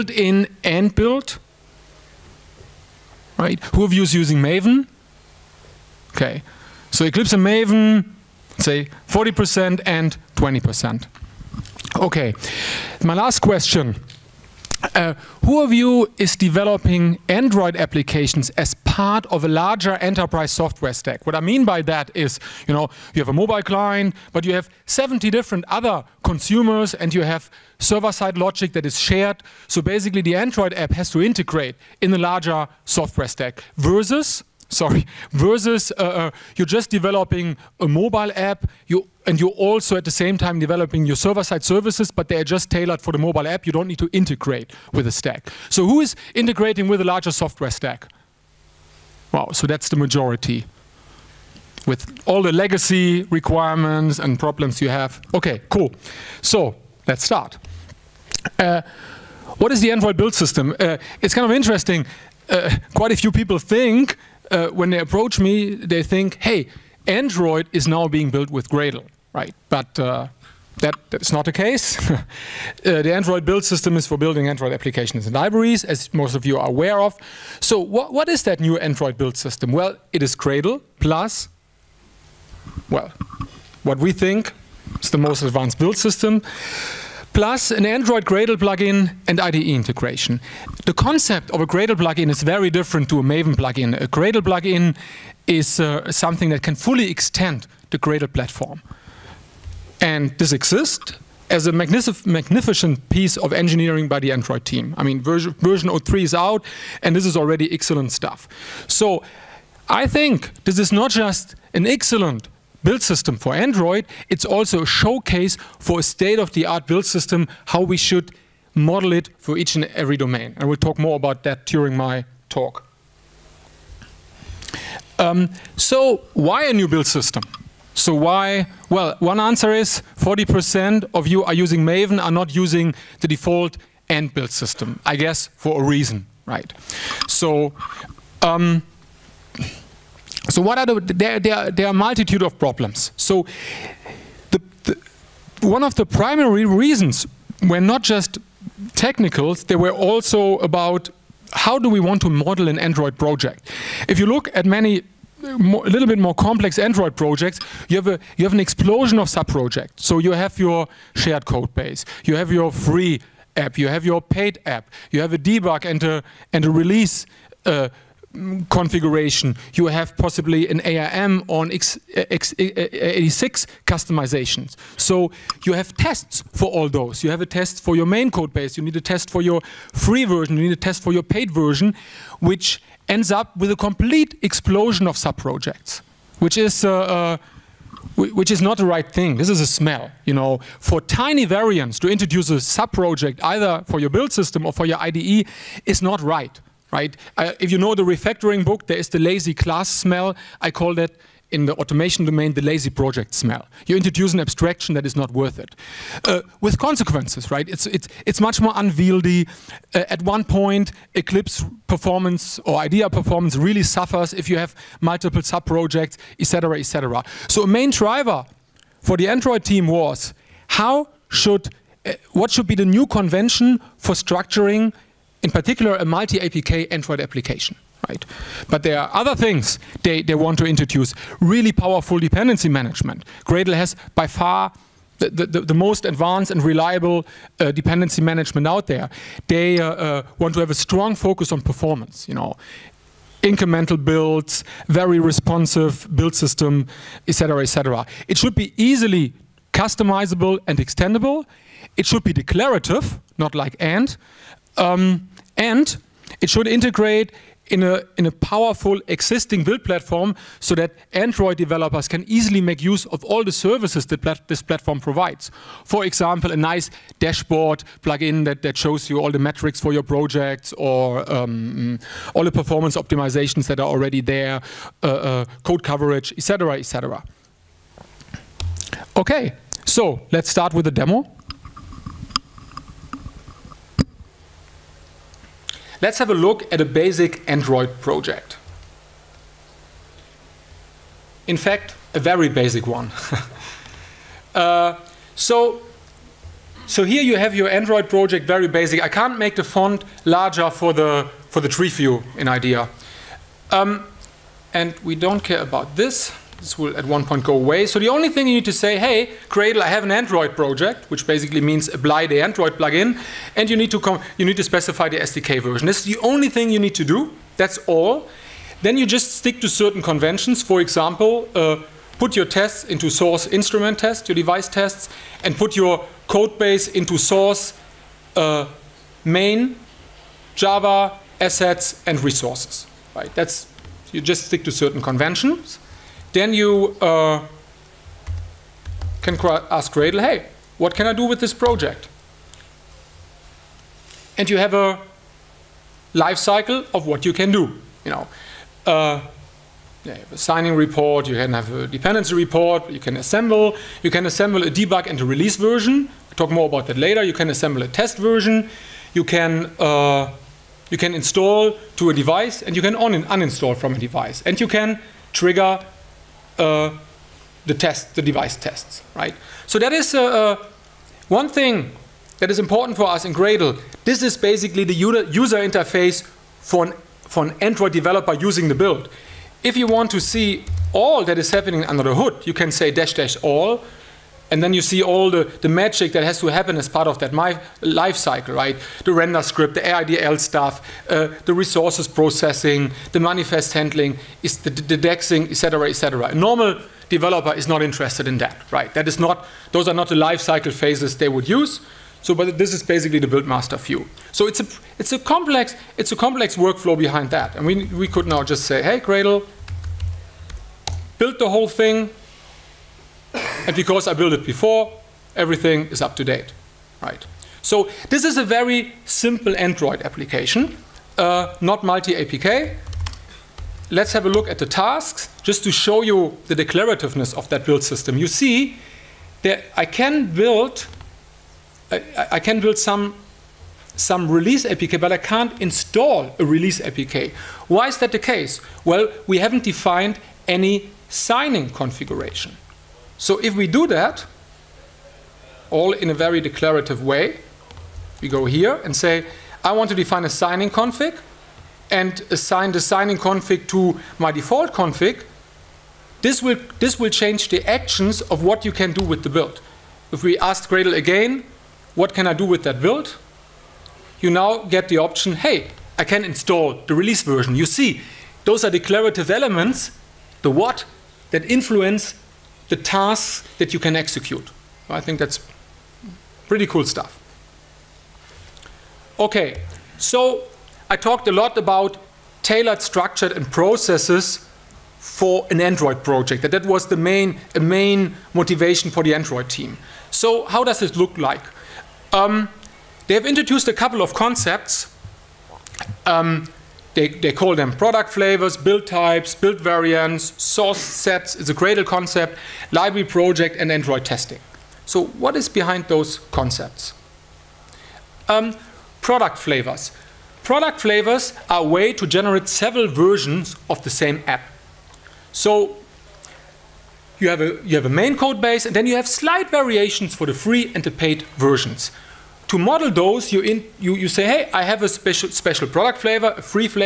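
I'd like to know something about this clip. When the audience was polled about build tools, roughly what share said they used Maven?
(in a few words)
20%.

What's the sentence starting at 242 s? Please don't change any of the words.
You know, incremental builds, very responsive build system, etc., etc.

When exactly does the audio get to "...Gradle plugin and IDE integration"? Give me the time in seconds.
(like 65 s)
88 s.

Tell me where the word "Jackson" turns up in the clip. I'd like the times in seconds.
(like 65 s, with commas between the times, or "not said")
not said.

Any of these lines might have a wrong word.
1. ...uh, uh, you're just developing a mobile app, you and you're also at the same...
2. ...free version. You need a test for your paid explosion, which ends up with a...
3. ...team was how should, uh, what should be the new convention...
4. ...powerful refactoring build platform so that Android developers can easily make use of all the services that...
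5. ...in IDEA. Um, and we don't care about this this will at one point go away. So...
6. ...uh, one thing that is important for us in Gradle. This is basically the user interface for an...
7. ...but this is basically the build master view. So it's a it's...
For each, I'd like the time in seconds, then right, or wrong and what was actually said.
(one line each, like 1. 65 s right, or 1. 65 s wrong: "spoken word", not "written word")
1. 35 s right
2. 179 s wrong: "version", not "explosion"
3. 219 s right
4. 258 s wrong: "existing", not "refactoring"
5. 302 s right
6. 370 s right
7. 402 s right.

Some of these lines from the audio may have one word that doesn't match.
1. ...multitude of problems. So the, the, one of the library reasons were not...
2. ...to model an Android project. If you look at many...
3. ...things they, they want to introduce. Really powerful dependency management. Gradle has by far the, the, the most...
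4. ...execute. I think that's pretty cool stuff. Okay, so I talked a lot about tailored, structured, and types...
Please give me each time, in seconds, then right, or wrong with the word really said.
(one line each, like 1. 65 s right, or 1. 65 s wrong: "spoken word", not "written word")
1. 141 s wrong: "primary", not "library"
2. 152 s right
3. 229 s right
4. 473 s wrong: "processes", not "types".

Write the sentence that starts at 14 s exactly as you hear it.
Uh, who of you is developing Android applications as part of a larger enterprise software stack?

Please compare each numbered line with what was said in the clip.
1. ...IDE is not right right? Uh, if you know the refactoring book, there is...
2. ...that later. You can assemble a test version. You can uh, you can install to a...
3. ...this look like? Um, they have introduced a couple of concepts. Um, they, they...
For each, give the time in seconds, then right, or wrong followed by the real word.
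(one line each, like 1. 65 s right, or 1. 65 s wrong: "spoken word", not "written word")
1. 195 s right
2. 356 s right
3. 490 s right.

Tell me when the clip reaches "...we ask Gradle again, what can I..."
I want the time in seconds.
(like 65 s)
460 s.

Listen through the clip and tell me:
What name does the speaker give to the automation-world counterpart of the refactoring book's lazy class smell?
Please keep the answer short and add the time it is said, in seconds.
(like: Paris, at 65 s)
lazy project smell, at 202 s.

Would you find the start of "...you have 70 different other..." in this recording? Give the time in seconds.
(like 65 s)
24 s.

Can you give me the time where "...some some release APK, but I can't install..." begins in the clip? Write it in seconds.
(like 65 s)
432 s.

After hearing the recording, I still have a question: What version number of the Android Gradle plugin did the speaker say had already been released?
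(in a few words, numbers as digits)
03.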